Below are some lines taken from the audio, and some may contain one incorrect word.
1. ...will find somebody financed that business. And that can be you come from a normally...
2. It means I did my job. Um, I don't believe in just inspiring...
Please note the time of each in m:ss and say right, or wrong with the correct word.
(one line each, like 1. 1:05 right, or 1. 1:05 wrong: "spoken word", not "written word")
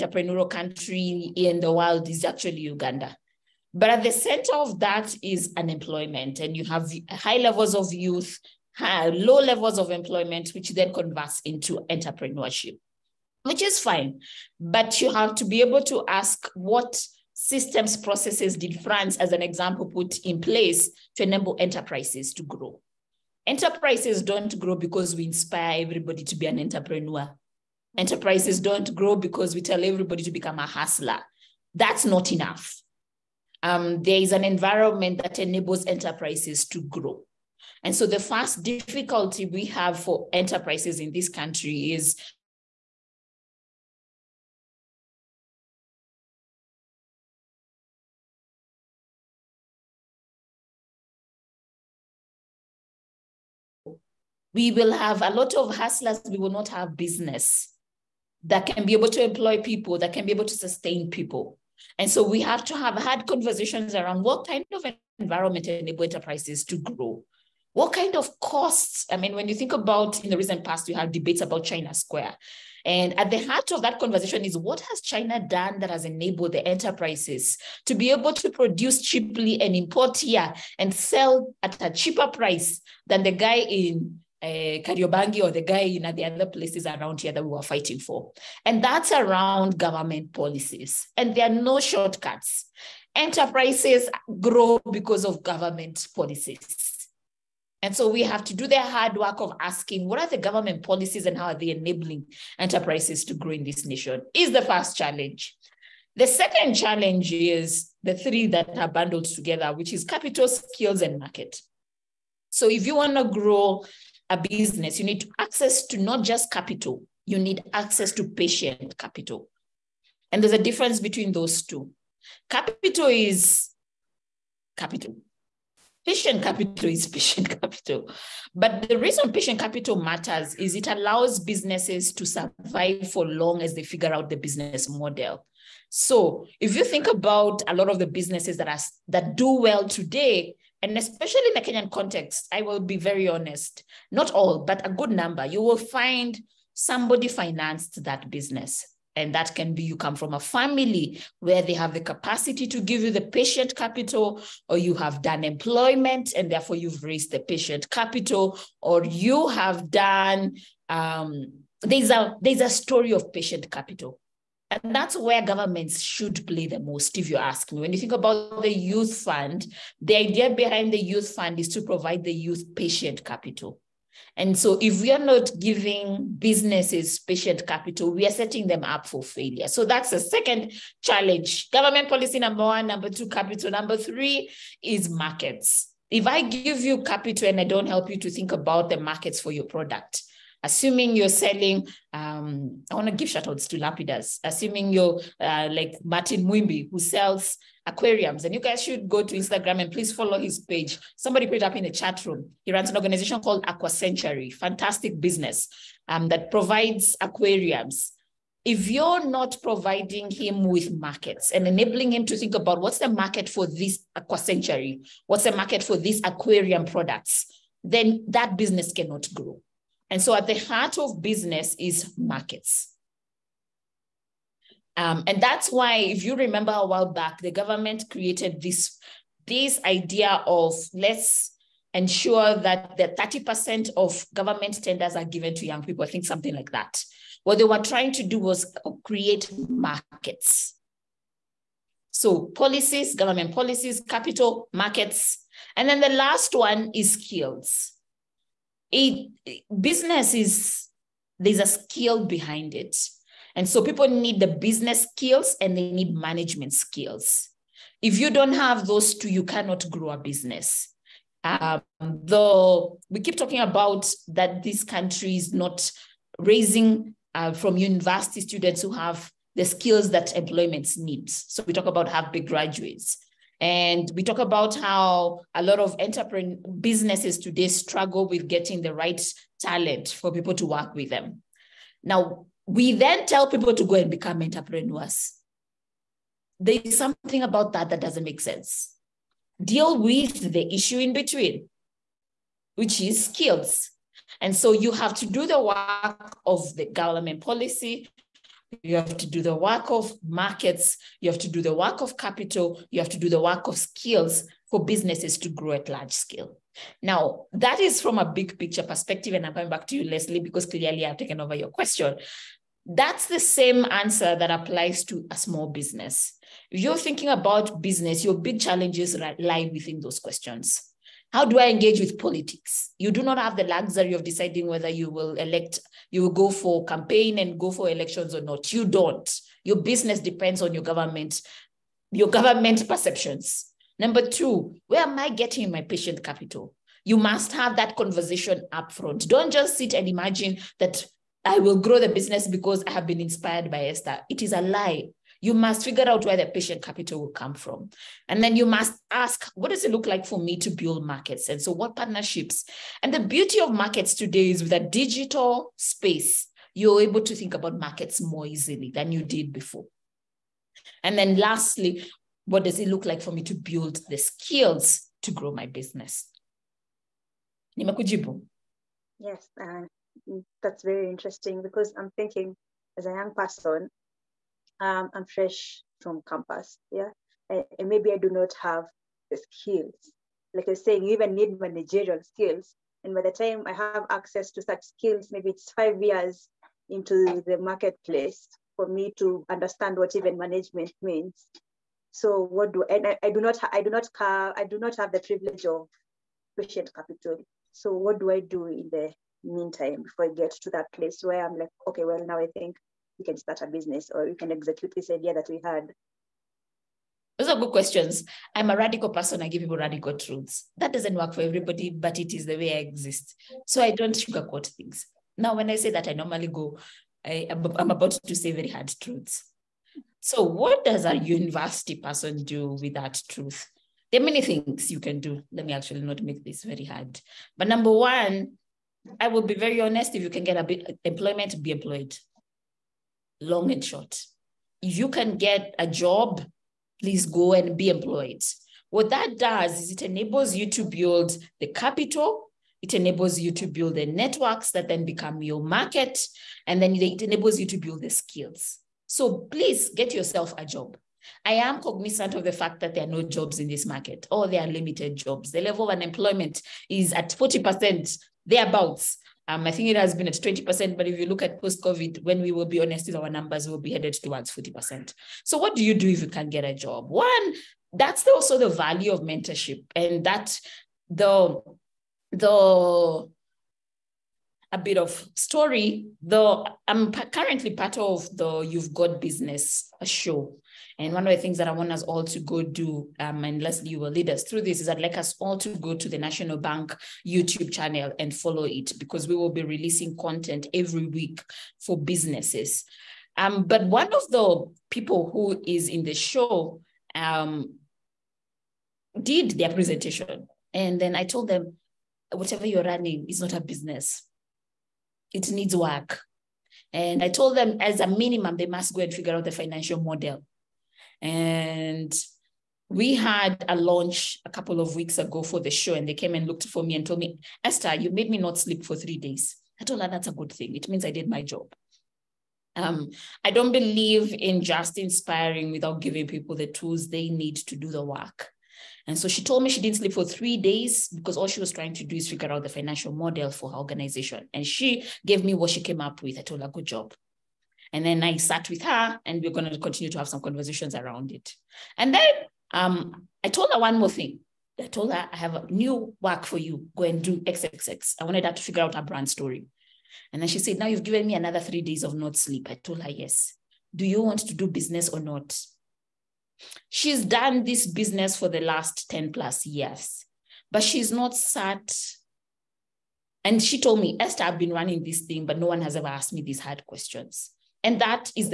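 1. 2:25 wrong: "family", not "normally"
2. 8:40 right.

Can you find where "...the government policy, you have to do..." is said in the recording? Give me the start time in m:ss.
4:56.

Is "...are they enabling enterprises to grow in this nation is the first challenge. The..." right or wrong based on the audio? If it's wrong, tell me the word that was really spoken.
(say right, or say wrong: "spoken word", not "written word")
right.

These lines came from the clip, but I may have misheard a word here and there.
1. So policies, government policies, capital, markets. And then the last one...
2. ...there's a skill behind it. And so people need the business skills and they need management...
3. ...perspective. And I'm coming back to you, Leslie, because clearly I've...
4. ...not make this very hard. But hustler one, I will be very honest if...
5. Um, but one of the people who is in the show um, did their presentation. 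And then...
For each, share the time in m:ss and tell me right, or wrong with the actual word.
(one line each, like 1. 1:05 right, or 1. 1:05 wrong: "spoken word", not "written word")
1. 4:02 right
2. 4:11 right
3. 5:08 right
4. 7:06 wrong: "number", not "hustler"
5. 8:13 right.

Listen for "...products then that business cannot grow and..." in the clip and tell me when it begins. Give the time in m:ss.
3:36.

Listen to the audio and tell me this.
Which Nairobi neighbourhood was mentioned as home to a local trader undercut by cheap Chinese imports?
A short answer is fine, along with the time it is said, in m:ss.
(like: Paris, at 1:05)
Kariobangi, at 1:24.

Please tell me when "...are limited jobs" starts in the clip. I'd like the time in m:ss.
7:34.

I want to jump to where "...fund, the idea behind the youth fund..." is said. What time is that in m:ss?
2:49.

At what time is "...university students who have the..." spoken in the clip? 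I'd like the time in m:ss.
4:27.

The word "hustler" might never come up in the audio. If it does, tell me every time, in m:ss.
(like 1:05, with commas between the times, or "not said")
0:30, 0:55.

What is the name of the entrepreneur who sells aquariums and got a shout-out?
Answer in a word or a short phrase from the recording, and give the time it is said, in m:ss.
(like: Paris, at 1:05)
Martin Mwimbi, at 3:16.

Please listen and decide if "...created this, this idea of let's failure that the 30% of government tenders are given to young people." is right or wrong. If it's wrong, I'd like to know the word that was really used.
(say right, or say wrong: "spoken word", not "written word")
wrong: "ensure", not "failure".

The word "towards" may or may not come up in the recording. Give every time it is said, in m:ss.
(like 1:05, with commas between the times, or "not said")
7:44.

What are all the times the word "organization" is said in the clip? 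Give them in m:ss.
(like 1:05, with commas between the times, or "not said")
3:22, 8:53.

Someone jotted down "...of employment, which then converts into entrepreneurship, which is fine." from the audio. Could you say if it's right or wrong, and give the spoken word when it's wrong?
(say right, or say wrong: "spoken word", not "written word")
right.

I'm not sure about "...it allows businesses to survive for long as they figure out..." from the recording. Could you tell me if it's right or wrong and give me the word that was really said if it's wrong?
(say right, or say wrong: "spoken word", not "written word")
right.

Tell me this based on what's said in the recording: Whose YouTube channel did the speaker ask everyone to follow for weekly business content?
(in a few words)
National Bank.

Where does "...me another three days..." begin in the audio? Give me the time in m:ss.
9:11.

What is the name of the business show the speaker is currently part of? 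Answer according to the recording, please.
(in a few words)
You've Got Business.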